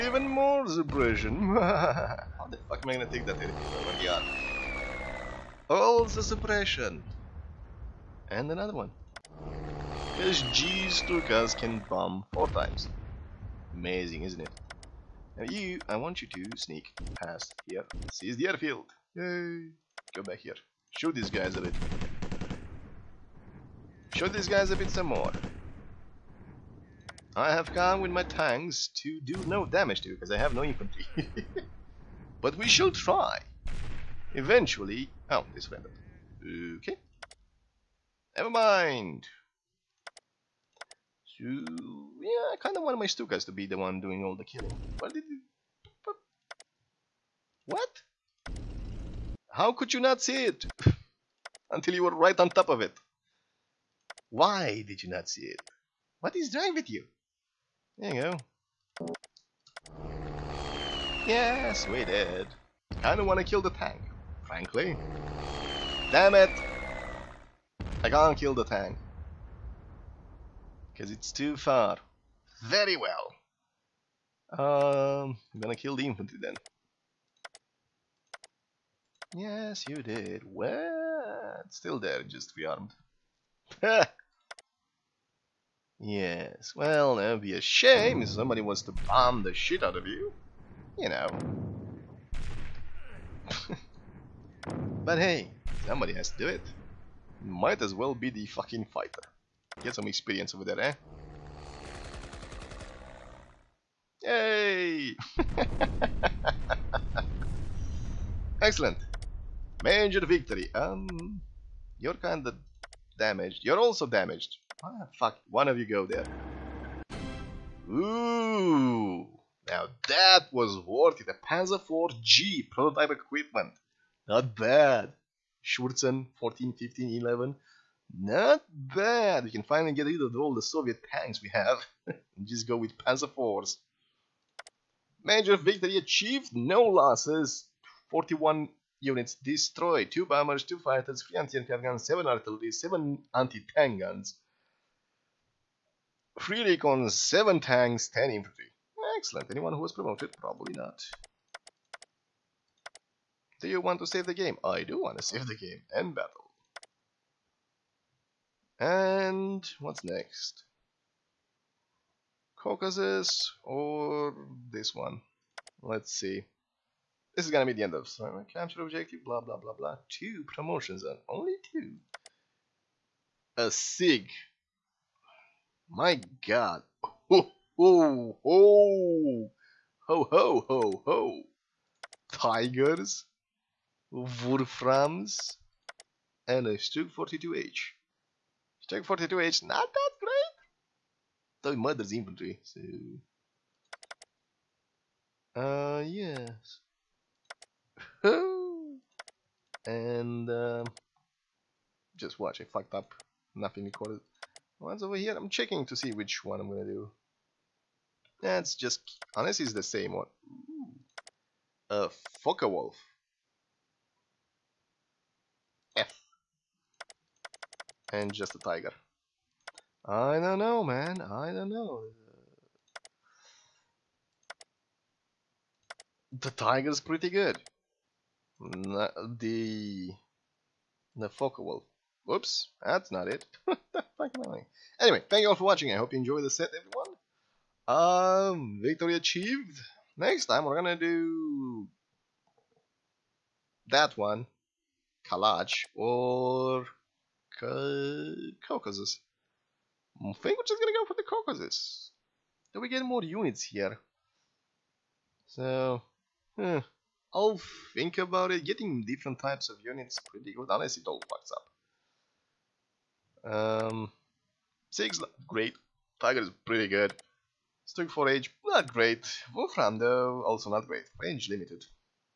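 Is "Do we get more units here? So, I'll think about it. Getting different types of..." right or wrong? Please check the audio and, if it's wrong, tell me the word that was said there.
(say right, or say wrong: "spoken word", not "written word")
right.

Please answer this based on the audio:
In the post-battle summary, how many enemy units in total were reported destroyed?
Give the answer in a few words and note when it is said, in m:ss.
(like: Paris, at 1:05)
41, at 2:18.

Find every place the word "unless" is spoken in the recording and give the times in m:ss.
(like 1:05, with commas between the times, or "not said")
3:29, 4:20.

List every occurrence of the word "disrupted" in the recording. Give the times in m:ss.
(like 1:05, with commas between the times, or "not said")
not said.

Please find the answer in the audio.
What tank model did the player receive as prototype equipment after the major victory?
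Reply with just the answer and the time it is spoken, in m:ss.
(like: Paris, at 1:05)
Panzer IV G, at 2:01.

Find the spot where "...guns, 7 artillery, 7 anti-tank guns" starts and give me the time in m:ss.
2:21.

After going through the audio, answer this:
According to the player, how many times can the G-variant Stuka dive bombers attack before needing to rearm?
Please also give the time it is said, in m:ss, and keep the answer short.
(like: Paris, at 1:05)
4, at 0:12.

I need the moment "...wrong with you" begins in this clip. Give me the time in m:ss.
0:56.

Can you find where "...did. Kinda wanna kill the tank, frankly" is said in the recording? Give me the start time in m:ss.
1:02.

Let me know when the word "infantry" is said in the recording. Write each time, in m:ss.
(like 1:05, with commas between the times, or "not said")
0:30, 1:16, 2:28, 3:12.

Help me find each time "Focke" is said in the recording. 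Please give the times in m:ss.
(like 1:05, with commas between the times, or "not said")
3:32, 3:51.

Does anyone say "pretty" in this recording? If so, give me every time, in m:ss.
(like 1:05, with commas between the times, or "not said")
3:47, 4:20, 4:26.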